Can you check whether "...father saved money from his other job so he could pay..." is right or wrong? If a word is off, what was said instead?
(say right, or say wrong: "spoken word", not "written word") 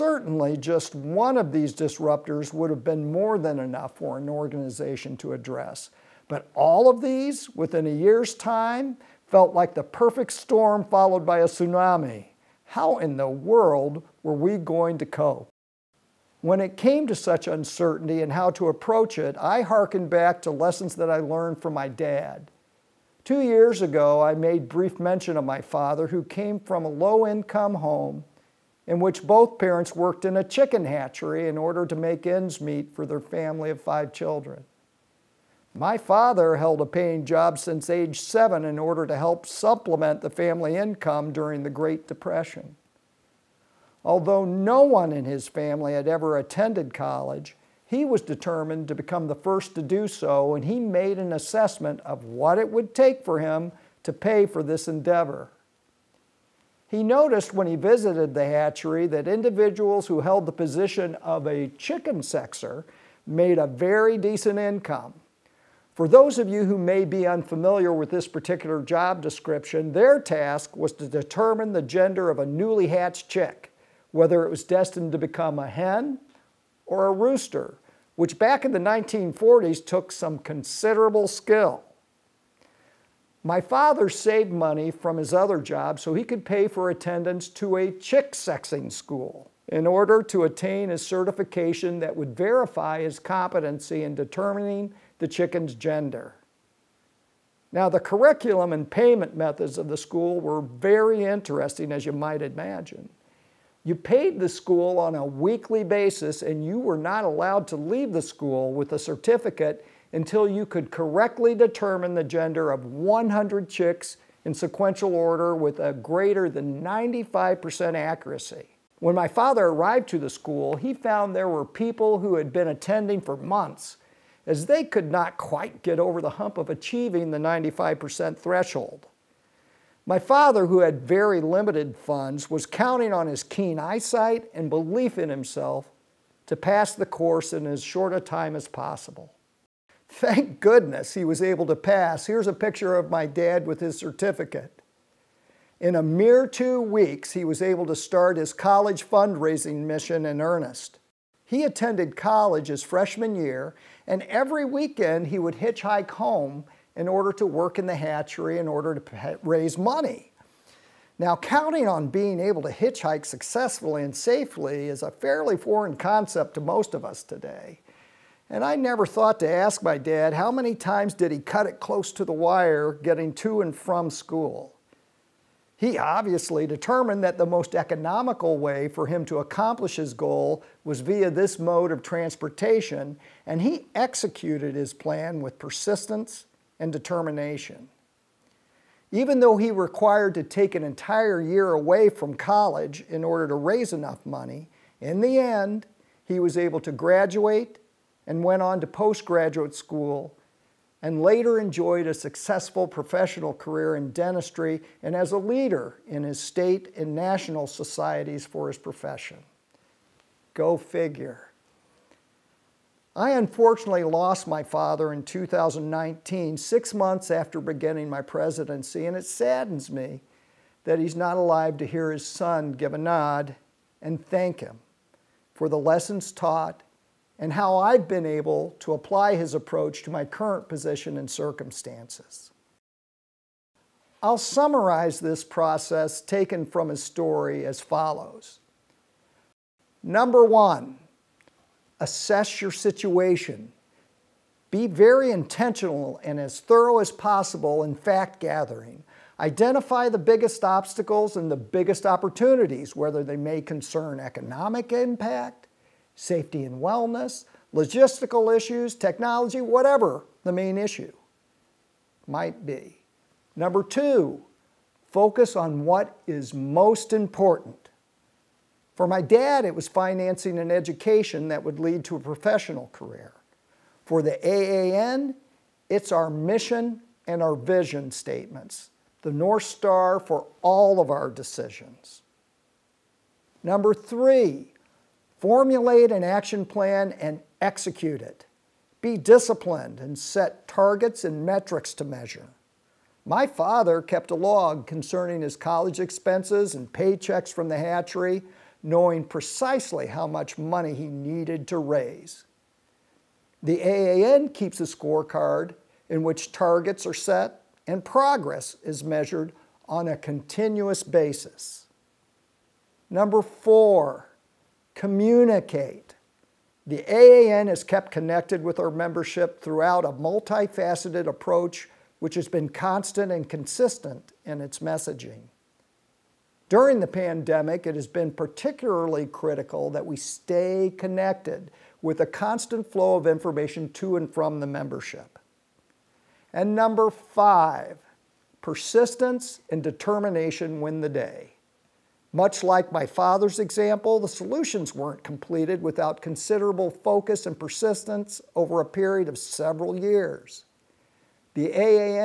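right.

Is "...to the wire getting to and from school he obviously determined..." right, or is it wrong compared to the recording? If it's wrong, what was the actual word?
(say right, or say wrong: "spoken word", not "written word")
right.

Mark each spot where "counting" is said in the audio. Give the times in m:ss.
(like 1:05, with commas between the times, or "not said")
2:12, 2:41.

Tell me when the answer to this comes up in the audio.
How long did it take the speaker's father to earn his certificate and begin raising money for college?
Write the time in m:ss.
2:26.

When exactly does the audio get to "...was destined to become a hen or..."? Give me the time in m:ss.
1:14.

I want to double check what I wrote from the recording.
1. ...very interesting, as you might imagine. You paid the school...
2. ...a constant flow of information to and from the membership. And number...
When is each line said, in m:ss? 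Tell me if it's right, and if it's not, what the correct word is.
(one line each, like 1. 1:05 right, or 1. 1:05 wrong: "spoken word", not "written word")
1. 1:40 right
2. 5:32 right.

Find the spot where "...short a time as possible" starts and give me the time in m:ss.
2:17.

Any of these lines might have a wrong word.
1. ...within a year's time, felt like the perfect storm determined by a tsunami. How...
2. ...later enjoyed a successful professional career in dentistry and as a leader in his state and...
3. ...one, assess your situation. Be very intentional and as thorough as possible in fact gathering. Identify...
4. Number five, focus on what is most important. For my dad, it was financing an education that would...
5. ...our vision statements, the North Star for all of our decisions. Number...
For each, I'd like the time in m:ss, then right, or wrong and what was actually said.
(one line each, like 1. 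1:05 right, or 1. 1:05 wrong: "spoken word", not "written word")
1. 0:07 wrong: "followed", not "determined"
2. 3:21 right
3. 4:00 right
4. 4:23 wrong: "two", not "five"
5. 4:37 right.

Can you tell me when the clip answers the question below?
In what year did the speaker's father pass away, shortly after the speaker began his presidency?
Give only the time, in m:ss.
3:35.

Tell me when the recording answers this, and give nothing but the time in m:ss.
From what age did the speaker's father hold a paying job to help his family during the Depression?
0:38.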